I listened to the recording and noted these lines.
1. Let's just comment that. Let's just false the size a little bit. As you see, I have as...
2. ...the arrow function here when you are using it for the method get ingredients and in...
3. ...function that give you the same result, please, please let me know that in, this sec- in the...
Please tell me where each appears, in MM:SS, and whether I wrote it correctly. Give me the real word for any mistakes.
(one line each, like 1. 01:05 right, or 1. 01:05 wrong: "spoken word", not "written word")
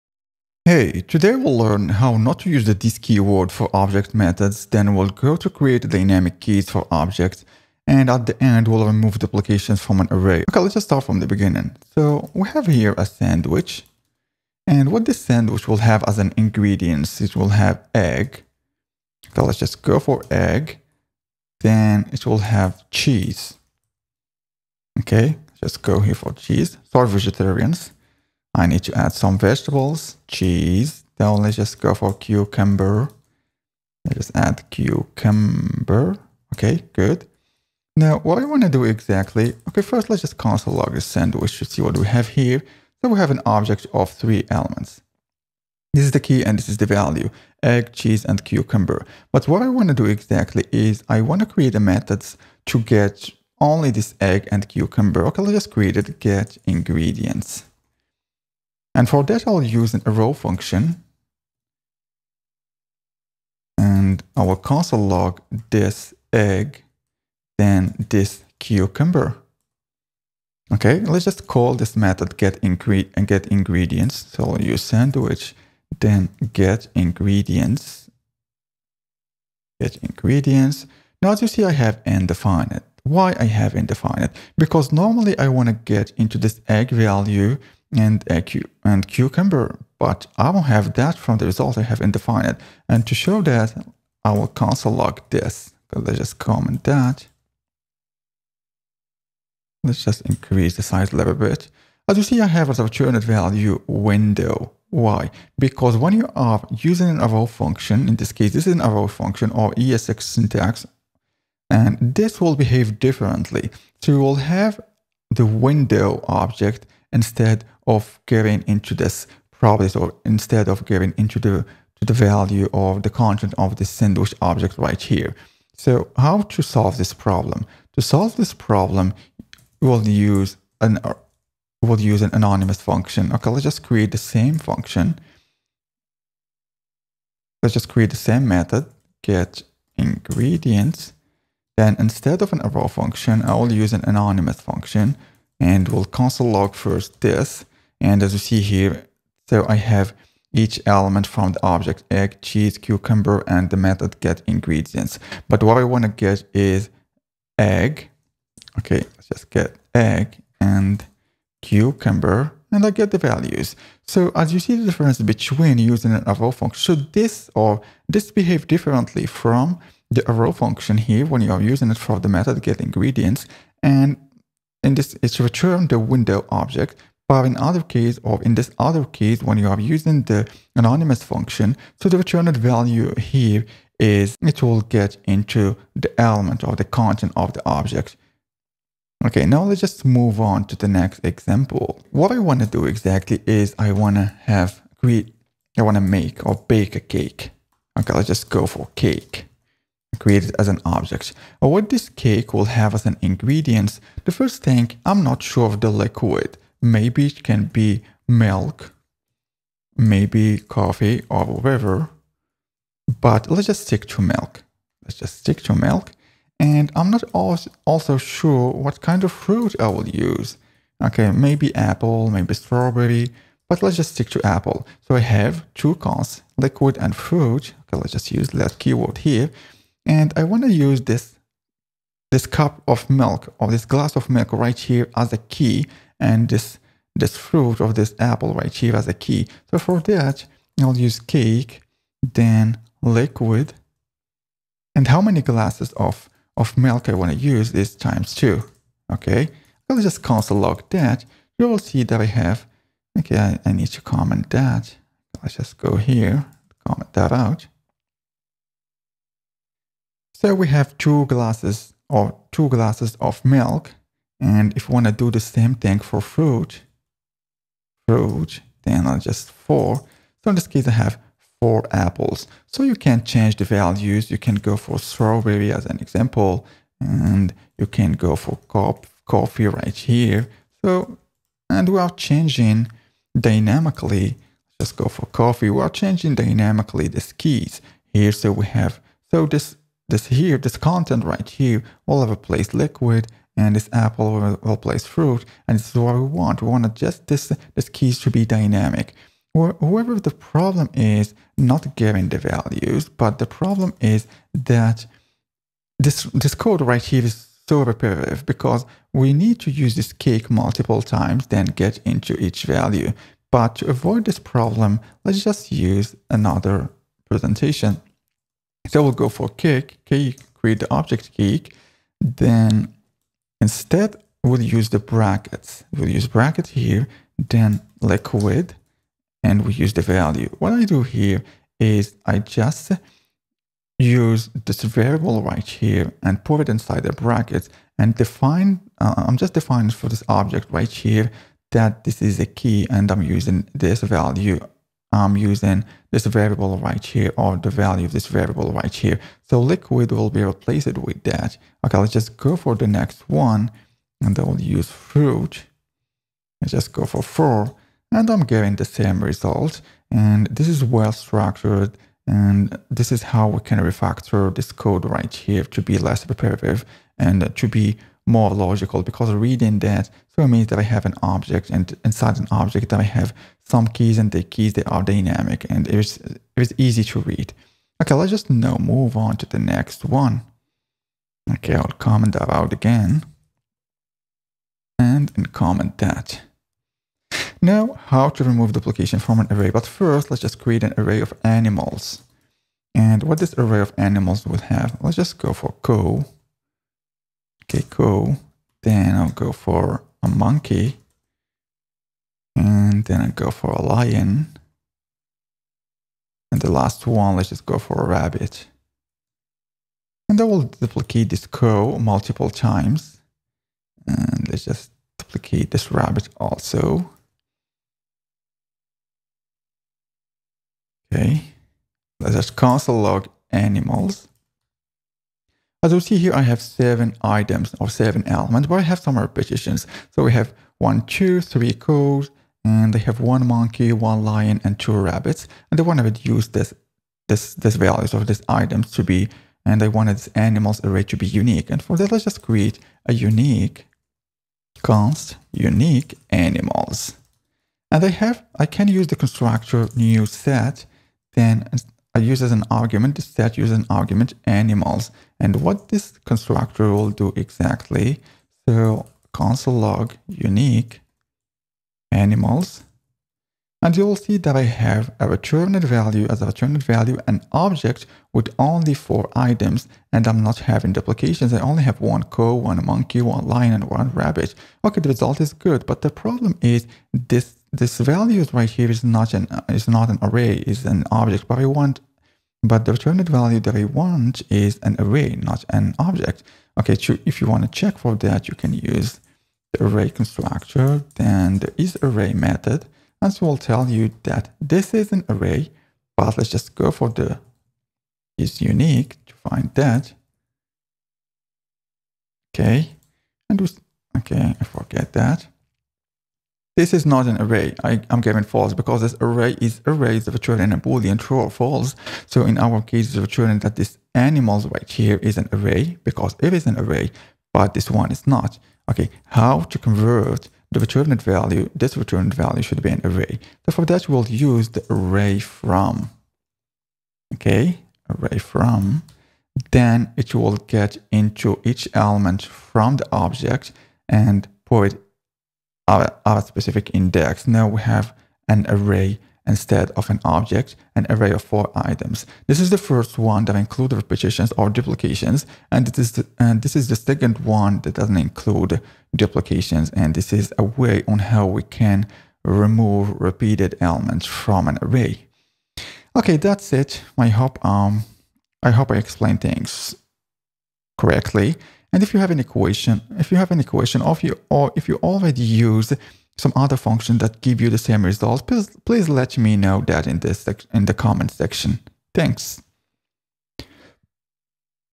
1. 01:35 wrong: "increase", not "false"
2. 02:50 right
3. 09:26 right.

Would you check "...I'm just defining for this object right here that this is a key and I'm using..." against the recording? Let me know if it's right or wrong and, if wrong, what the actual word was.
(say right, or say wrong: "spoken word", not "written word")
right.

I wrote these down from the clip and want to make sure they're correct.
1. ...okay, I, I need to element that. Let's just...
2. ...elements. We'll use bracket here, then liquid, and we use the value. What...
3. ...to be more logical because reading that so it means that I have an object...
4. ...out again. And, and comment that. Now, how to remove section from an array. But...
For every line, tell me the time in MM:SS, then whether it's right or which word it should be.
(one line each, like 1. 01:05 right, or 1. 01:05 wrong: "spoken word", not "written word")
1. 04:13 wrong: "comment", not "element"
2. 05:24 wrong: "brackets", not "elements"
3. 06:07 right
4. 06:22 wrong: "duplication", not "section".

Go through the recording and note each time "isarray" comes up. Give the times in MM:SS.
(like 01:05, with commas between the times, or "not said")
08:11.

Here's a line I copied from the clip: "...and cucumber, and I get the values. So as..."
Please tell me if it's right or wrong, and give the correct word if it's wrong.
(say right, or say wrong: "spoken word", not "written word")
right.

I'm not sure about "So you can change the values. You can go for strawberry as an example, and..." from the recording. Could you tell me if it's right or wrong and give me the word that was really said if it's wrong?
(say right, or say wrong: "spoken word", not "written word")
right.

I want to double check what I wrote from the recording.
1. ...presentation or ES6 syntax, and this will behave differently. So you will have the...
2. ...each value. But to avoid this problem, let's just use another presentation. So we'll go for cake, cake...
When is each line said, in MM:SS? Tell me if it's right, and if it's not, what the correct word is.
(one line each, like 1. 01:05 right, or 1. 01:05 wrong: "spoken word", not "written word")
1. 01:49 wrong: "function", not "presentation"
2. 05:12 right.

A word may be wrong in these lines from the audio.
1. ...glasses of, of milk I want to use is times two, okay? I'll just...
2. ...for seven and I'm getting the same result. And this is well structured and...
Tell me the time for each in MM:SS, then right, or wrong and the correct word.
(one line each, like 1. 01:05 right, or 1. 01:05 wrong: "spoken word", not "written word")
1. 04:05 right
2. 05:57 wrong: "four", not "seven".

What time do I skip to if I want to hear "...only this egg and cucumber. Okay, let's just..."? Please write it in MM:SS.
00:53.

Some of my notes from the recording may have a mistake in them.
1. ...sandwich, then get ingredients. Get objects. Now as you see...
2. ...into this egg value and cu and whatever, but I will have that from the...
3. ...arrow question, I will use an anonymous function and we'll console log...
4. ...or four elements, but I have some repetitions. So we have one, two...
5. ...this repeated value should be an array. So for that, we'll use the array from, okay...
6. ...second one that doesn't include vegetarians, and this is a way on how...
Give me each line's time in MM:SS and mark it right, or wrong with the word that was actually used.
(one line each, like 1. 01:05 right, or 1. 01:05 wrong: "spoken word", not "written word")
1. 01:14 wrong: "ingredients", not "objects"
2. 01:26 wrong: "cucumber", not "whatever"
3. 02:22 wrong: "function", not "question"
4. 07:07 wrong: "seven", not "four"
5. 08:41 wrong: "returned", not "repeated"
6. 09:06 wrong: "duplications", not "vegetarians".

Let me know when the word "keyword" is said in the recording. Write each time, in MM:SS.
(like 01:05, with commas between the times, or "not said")
00:02, 03:48.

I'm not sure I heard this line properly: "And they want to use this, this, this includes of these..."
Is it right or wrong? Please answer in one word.
wrong.